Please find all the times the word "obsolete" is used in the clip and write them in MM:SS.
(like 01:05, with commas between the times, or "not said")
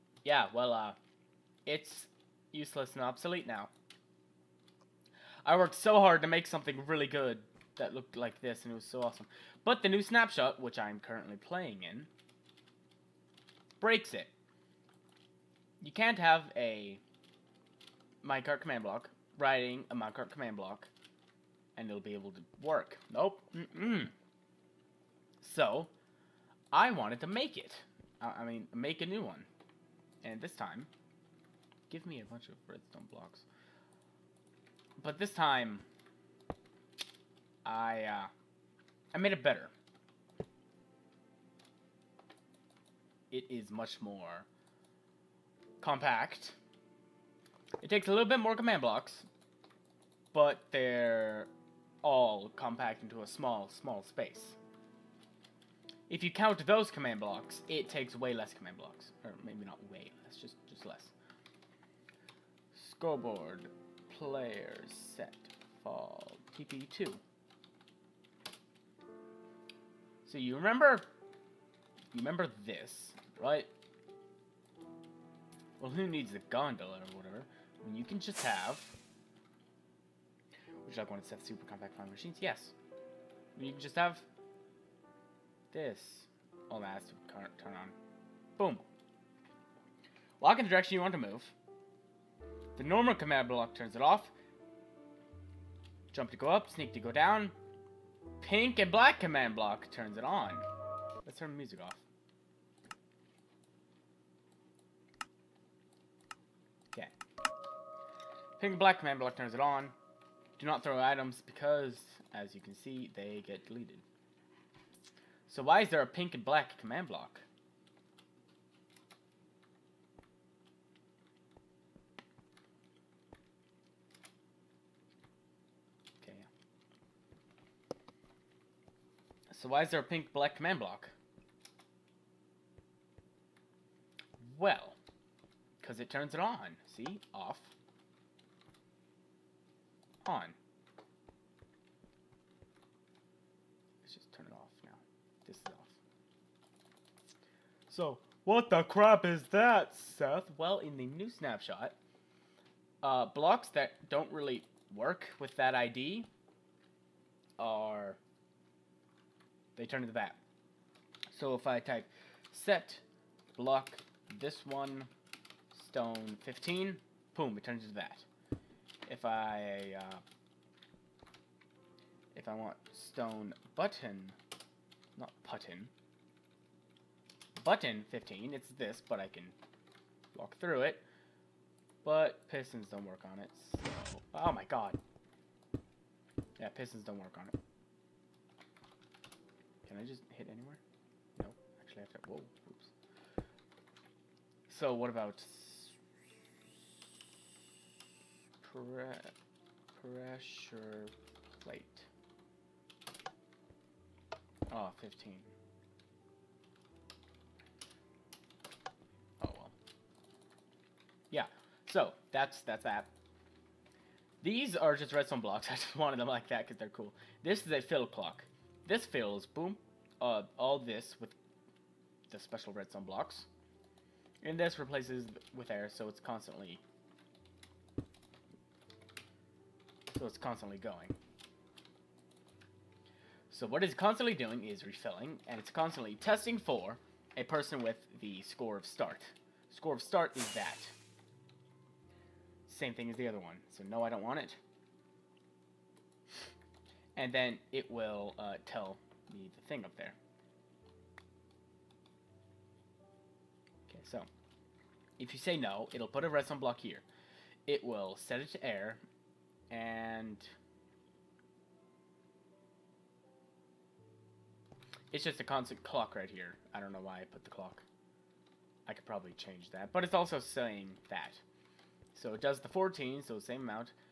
00:03.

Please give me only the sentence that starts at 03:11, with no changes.
No, actually I have to, whoa, oops.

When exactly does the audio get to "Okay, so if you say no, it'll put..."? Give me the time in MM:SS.
04:13.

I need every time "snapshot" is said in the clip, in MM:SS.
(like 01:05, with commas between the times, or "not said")
00:10, 02:31.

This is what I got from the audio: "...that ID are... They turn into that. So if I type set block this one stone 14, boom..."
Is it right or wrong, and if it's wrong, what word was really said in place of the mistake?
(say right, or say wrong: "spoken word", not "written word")
wrong: "15", not "14".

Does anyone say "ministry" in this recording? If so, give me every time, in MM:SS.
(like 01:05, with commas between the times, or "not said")
not said.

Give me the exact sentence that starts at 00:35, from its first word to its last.
But this time, I, uh, I made it better.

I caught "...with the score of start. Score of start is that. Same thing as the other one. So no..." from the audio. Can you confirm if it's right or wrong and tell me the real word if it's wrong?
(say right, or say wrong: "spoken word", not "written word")
right.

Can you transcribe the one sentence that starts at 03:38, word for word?
This fills, boom, uh, all this with the special redstone blocks.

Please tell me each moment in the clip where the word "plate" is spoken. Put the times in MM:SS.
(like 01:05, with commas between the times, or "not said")
03:21.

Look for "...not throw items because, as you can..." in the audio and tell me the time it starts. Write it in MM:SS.
01:50.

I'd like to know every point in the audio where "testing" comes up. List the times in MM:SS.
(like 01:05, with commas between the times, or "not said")
03:56.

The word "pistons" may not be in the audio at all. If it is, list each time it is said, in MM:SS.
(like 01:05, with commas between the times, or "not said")
03:02, 03:06.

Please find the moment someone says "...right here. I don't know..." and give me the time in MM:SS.
04:26.